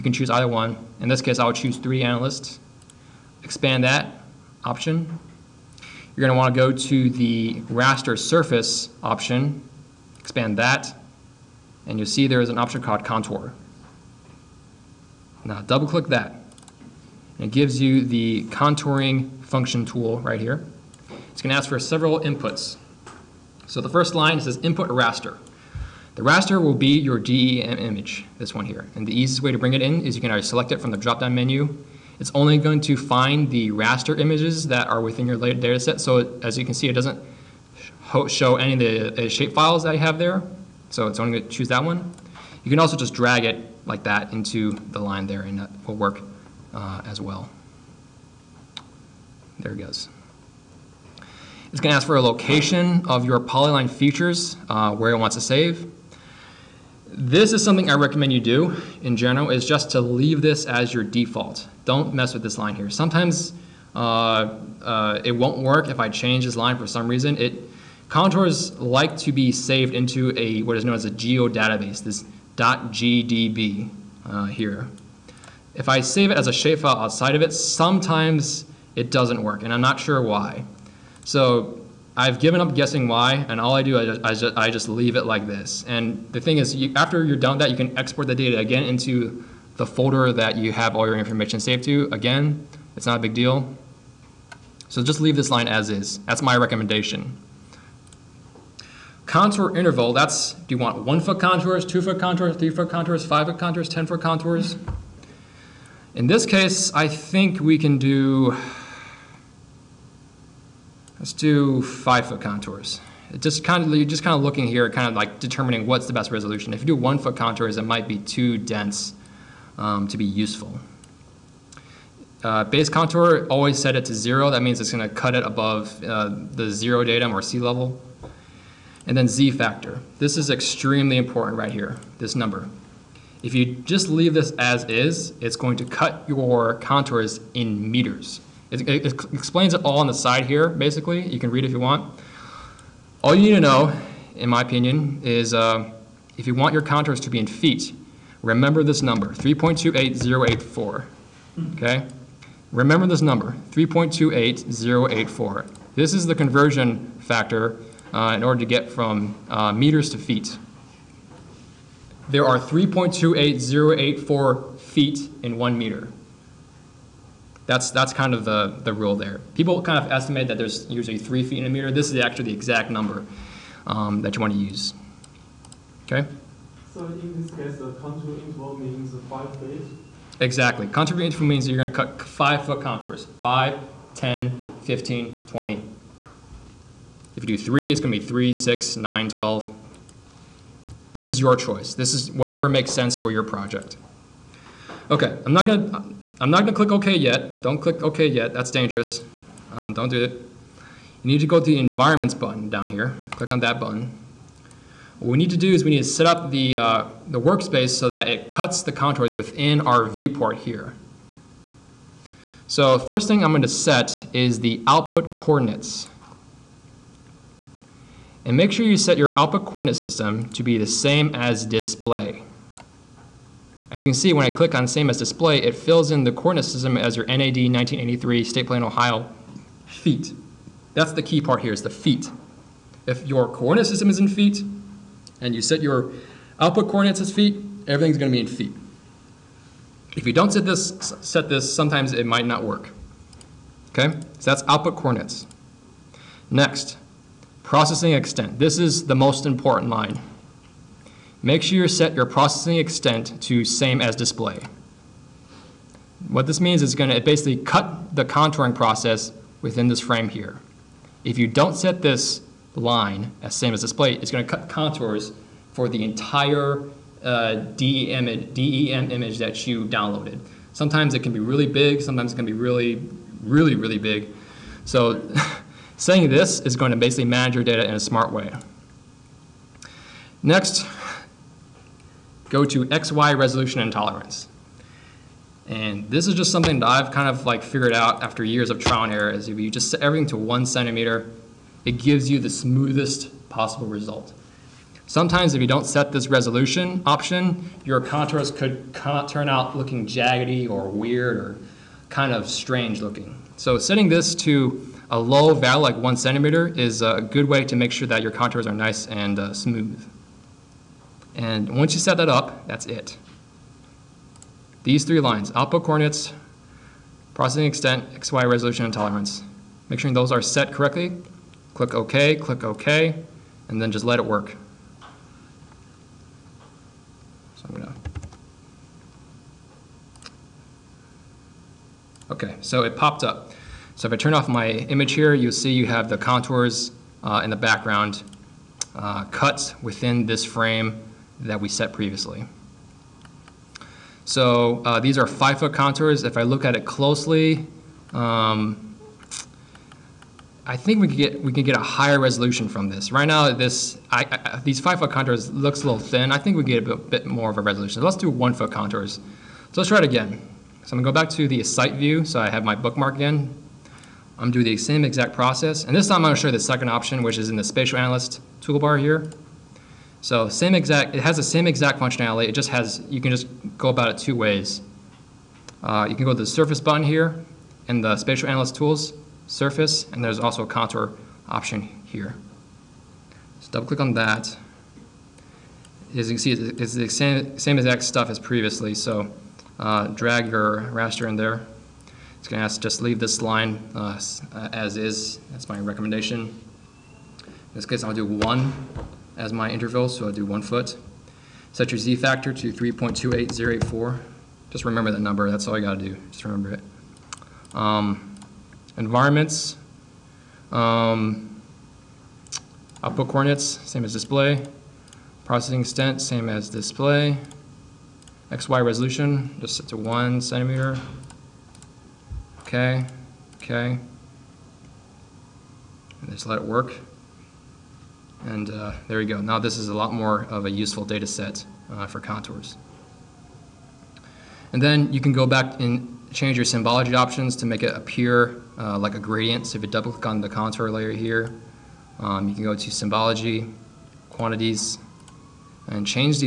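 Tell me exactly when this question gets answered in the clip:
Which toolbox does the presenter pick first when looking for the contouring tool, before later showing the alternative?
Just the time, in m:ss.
0:01.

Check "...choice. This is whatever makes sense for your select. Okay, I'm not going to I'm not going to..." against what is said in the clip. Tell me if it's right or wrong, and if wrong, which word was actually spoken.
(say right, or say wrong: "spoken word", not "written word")
wrong: "project", not "select".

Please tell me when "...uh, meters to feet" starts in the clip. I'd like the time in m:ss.
2:39.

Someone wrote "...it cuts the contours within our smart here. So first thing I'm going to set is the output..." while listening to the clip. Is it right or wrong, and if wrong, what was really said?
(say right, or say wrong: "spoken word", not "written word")
wrong: "viewport", not "smart".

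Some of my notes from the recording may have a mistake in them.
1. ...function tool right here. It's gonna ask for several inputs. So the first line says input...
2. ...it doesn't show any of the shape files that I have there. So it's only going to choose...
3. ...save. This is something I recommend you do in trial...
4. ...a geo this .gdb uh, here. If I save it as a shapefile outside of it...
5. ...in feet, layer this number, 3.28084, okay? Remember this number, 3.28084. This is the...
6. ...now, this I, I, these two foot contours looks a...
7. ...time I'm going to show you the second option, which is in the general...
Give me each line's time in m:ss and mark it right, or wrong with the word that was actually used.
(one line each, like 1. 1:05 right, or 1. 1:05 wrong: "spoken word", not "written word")
1. 0:19 right
2. 0:36 right
3. 0:55 wrong: "general", not "trial"
4. 1:11 right
5. 2:27 wrong: "remember", not "layer"
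6. 5:53 wrong: "five", not "two"
7. 6:06 wrong: "spatial", not "general".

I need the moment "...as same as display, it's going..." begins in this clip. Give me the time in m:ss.
4:23.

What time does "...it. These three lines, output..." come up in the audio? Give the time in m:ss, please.
5:12.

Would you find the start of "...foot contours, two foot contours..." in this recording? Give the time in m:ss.
1:41.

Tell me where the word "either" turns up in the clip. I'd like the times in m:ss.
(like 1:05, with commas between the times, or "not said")
0:00, 0:30.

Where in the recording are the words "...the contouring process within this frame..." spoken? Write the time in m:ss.
4:18.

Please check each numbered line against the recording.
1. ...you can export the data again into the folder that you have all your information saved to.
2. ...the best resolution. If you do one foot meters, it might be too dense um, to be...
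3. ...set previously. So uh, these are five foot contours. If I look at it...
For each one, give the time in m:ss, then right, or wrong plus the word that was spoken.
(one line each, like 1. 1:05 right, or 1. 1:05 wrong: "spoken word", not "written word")
1. 1:27 right
2. 1:56 wrong: "contours", not "meters"
3. 5:41 right.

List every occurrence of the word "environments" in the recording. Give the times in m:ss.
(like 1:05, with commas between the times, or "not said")
3:21, 6:48.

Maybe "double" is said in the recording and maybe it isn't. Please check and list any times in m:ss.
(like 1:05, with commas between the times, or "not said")
0:15, 6:23, 7:19.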